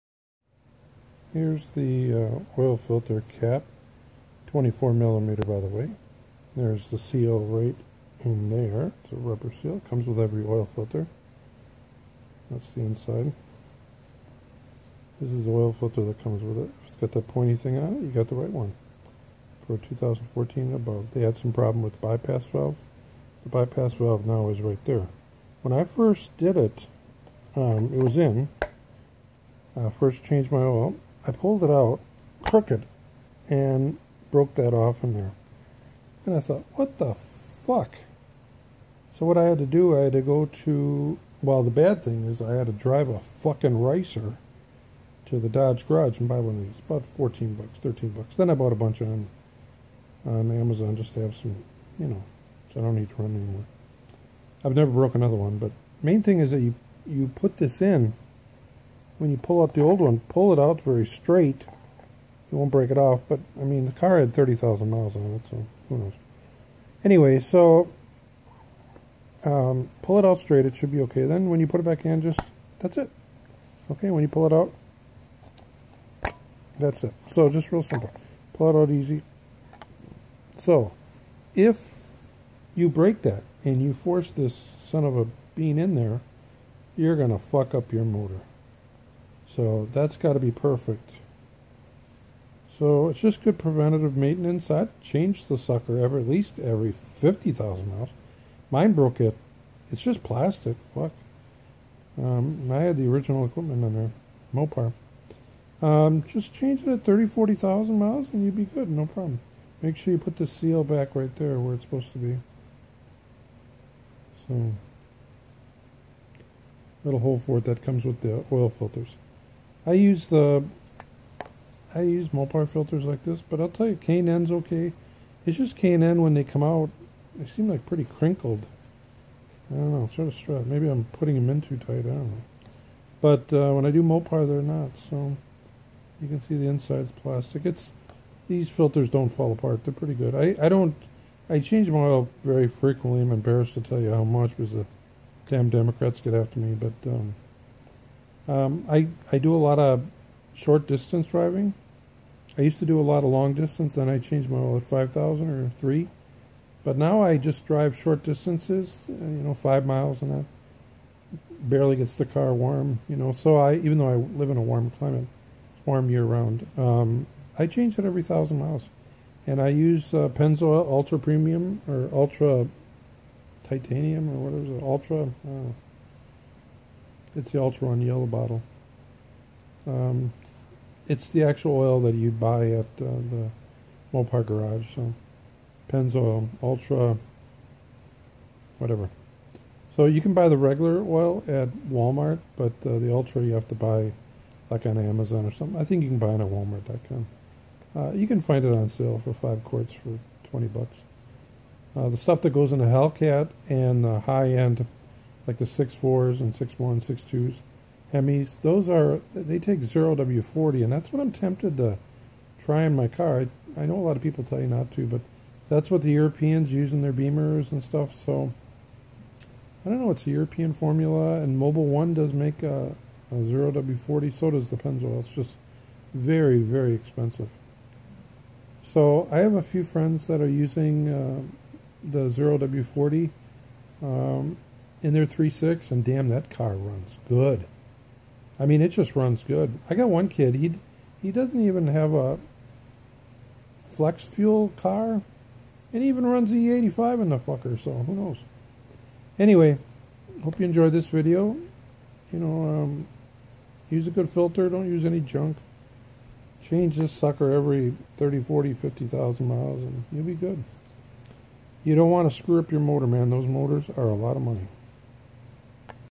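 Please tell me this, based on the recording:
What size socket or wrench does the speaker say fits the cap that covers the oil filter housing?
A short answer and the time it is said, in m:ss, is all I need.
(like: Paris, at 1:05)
24 millimeter, at 0:04.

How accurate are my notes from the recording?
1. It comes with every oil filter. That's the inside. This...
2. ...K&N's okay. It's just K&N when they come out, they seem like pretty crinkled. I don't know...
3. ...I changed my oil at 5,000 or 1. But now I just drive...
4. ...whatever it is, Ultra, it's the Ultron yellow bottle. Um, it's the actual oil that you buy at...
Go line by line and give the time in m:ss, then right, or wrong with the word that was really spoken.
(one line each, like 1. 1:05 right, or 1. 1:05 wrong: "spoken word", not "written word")
1. 0:09 right
2. 2:03 right
3. 2:34 wrong: "3", not "1"
4. 2:54 right.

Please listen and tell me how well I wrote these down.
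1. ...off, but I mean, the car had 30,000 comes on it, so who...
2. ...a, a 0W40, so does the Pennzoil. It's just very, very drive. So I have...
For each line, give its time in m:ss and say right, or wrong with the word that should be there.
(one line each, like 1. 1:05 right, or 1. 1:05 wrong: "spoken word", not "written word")
1. 1:02 wrong: "miles", not "comes"
2. 3:42 wrong: "expensive", not "drive".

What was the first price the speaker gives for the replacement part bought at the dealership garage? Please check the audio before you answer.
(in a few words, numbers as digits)
$14.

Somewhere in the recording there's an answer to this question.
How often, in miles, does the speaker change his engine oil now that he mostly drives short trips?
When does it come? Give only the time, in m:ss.
2:48.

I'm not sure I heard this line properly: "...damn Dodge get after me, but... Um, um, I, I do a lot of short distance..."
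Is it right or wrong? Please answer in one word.
wrong.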